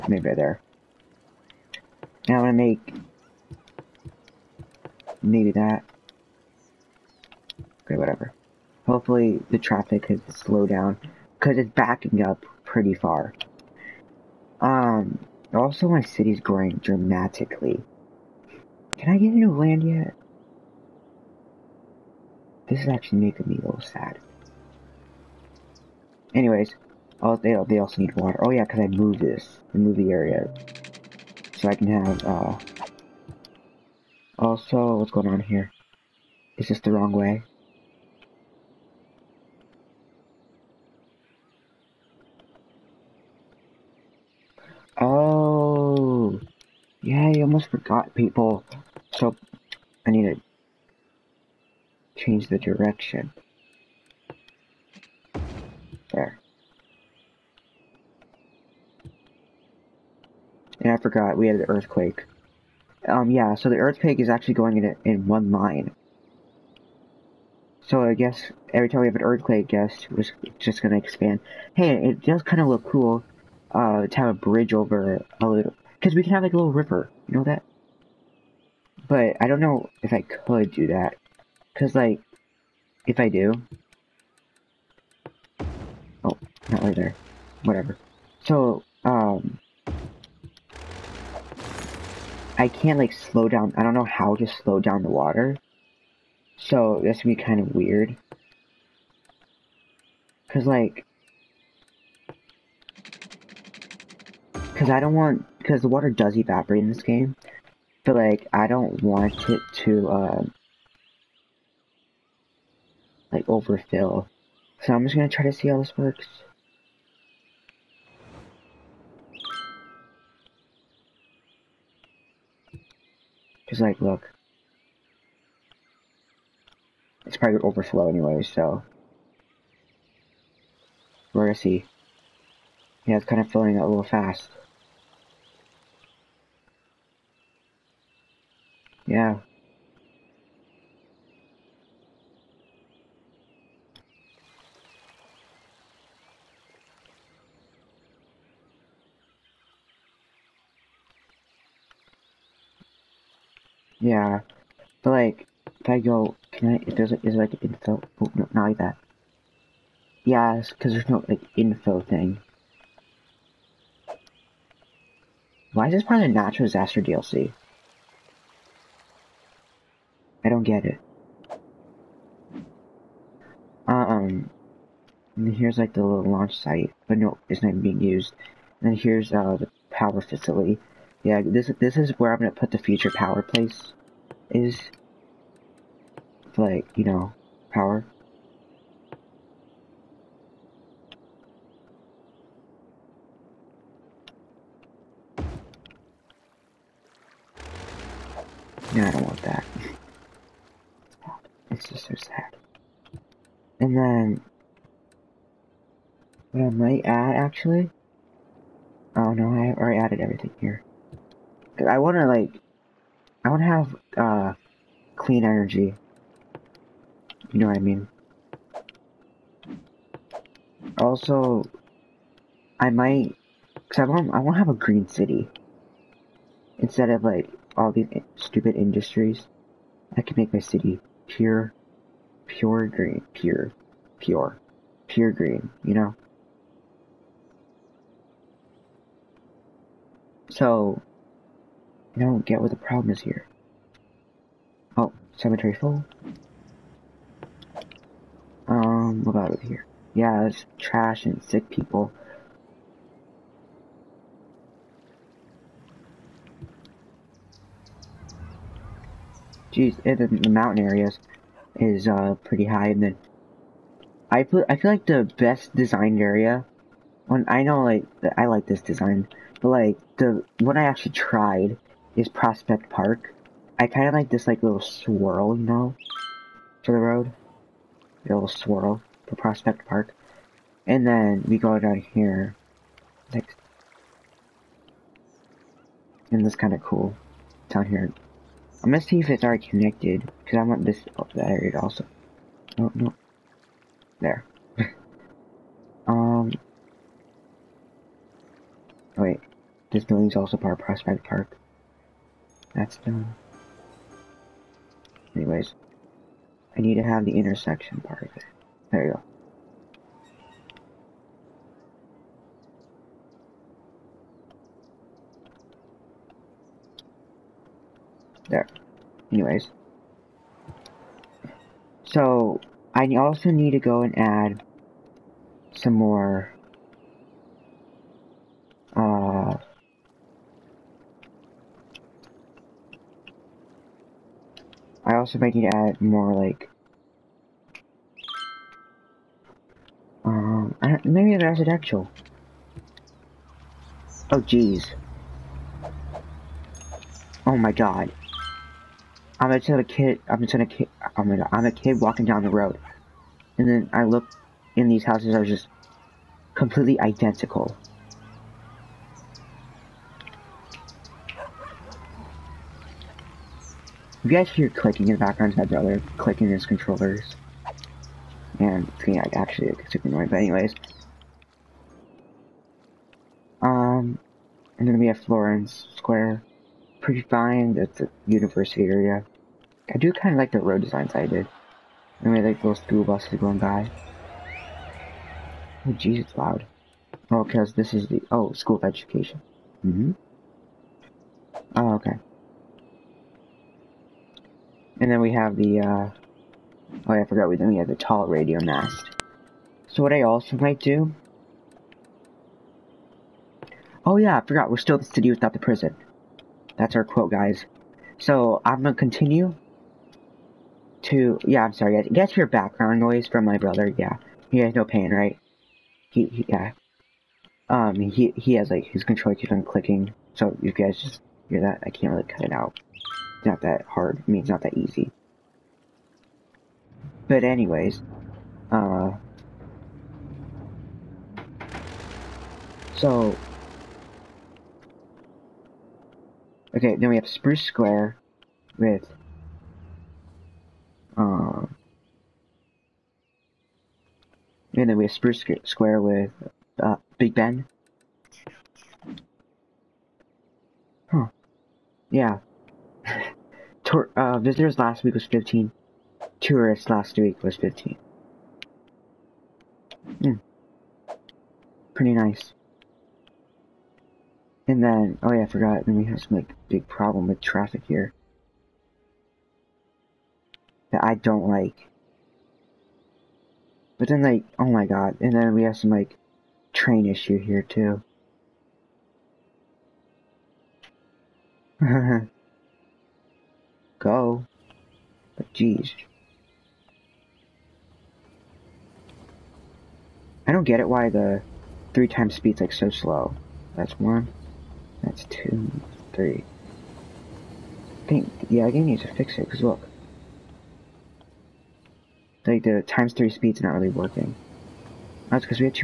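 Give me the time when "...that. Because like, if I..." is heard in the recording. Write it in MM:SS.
01:20.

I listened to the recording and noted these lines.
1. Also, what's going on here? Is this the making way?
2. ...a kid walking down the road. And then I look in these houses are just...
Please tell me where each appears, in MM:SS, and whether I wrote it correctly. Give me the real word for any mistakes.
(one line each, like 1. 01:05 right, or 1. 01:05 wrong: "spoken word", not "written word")
1. 00:34 wrong: "wrong", not "making"
2. 05:51 right.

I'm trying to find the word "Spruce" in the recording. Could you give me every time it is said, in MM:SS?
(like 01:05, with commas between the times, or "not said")
07:17, 07:25.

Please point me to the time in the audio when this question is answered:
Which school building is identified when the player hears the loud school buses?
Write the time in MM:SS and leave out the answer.
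06:28.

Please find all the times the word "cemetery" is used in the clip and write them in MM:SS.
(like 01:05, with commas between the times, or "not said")
04:05.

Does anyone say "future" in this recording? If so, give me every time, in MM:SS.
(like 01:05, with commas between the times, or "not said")
03:02.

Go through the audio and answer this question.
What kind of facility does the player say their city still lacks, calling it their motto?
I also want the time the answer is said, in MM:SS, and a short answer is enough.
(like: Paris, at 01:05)
prison, at 06:45.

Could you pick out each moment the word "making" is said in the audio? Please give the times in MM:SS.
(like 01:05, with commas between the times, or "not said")
00:23.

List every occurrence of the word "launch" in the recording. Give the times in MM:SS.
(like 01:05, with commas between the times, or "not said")
02:56.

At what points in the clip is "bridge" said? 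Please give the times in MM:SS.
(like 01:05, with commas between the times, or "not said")
01:14.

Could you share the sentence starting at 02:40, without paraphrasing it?
Yeah, because there's no like info thing.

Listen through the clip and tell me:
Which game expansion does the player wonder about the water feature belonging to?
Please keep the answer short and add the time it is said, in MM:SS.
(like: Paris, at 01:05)
natural disaster DLC, at 02:46.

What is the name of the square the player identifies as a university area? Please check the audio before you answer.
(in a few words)
Florence Square.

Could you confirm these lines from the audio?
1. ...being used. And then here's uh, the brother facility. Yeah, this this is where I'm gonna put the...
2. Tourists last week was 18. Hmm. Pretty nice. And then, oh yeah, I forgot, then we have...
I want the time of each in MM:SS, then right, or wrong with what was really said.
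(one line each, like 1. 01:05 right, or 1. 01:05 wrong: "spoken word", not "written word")
1. 02:57 wrong: "power", not "brother"
2. 07:36 wrong: "15", not "18".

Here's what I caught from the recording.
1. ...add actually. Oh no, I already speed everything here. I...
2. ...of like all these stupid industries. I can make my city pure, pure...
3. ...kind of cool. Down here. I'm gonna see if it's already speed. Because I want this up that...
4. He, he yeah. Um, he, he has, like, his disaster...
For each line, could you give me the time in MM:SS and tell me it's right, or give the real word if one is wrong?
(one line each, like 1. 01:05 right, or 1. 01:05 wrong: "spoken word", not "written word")
1. 03:27 wrong: "added", not "speed"
2. 03:47 right
3. 04:46 wrong: "connected", not "speed"
4. 06:56 wrong: "controller", not "disaster".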